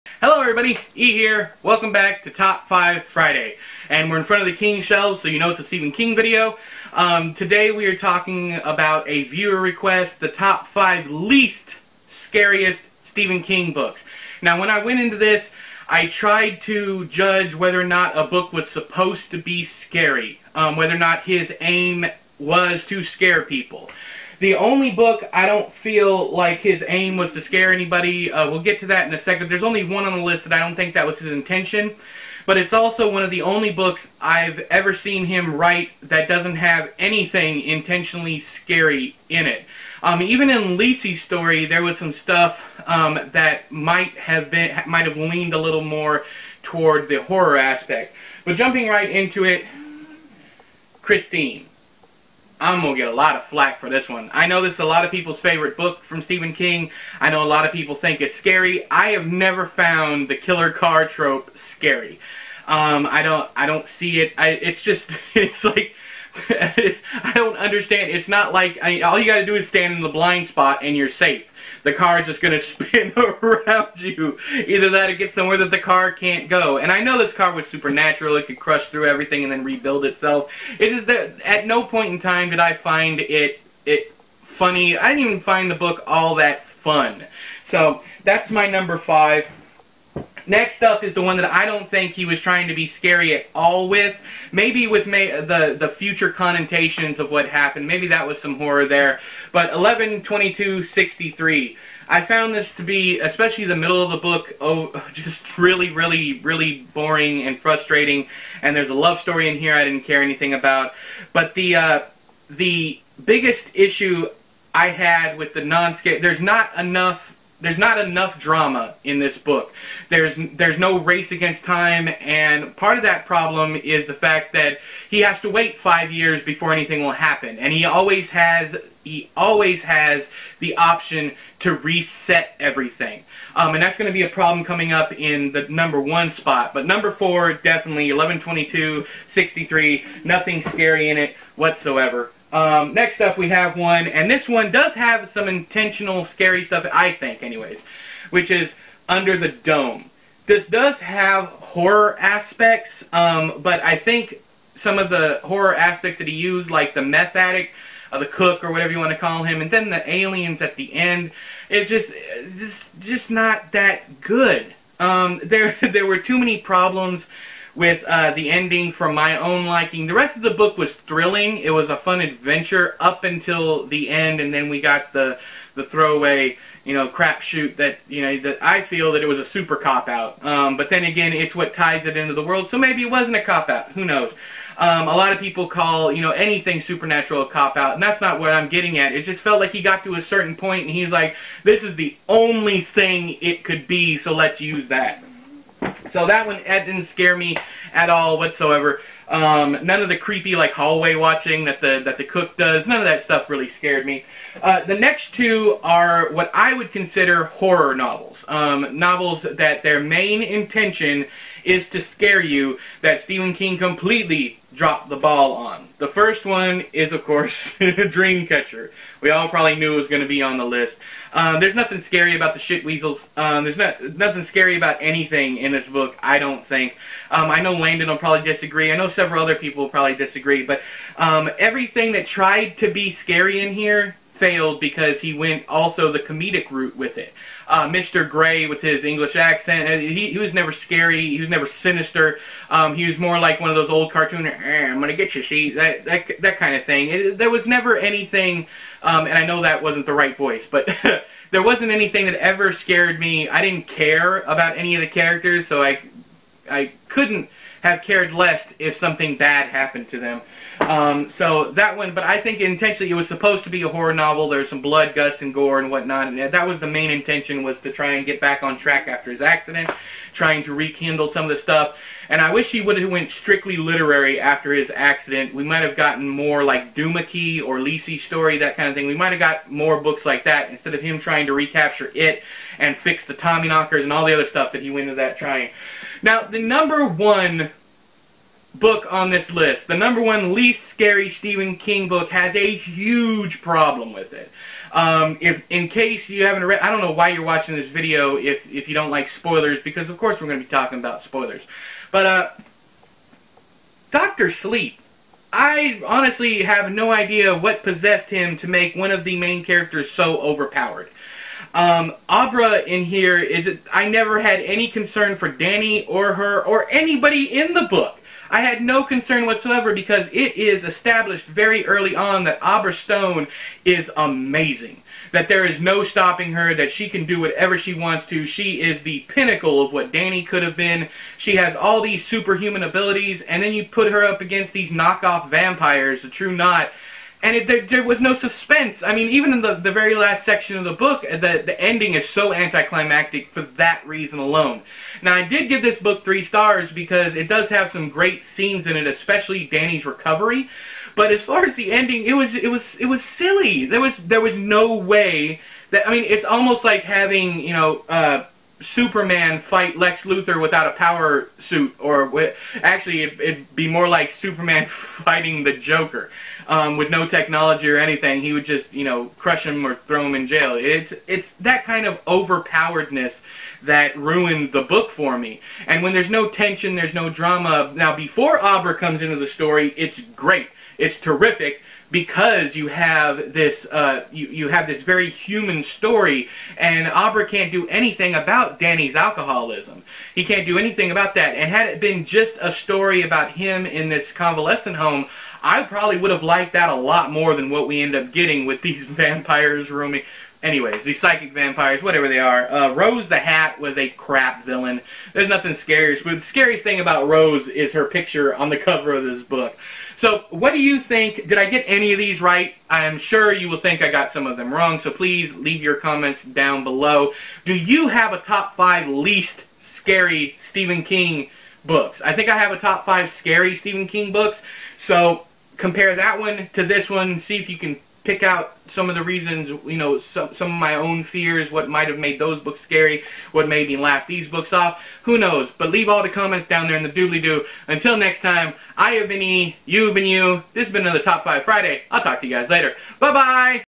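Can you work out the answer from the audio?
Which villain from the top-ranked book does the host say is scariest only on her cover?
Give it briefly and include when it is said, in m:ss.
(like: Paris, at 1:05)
Rose the Hat, at 6:42.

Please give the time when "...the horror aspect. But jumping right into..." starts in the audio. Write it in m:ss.
0:47.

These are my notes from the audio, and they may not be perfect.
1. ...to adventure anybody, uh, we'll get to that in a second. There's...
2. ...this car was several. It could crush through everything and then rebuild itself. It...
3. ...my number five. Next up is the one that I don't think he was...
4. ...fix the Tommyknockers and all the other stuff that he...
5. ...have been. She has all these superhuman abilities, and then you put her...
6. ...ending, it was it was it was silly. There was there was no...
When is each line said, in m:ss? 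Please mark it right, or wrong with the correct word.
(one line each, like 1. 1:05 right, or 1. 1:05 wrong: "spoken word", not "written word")
1. 0:27 wrong: "scare", not "adventure"
2. 1:17 wrong: "supernatural", not "several"
3. 1:28 right
4. 4:42 right
5. 5:30 right
6. 5:51 right.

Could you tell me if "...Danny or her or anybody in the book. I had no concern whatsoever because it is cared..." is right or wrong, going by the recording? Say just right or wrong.
wrong.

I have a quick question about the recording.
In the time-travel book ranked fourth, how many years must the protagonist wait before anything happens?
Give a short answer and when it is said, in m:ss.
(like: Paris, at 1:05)
5, at 2:05.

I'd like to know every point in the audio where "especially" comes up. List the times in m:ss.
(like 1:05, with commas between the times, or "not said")
1:43, 5:49.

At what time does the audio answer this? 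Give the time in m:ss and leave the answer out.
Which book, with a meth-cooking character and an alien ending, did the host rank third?
2:29.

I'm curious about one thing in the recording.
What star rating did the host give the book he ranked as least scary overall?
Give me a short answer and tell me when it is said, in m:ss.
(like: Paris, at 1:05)
3 stars, at 5:46.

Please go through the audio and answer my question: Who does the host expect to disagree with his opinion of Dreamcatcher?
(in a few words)
Landon.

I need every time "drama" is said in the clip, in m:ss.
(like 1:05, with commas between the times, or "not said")
1:58, 6:17.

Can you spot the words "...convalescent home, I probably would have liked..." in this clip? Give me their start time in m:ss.
6:34.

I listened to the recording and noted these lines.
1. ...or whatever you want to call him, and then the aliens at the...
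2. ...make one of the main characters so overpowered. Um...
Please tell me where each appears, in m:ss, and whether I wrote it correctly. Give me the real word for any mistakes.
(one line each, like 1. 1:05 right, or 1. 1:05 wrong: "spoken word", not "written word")
1. 2:38 right
2. 5:08 right.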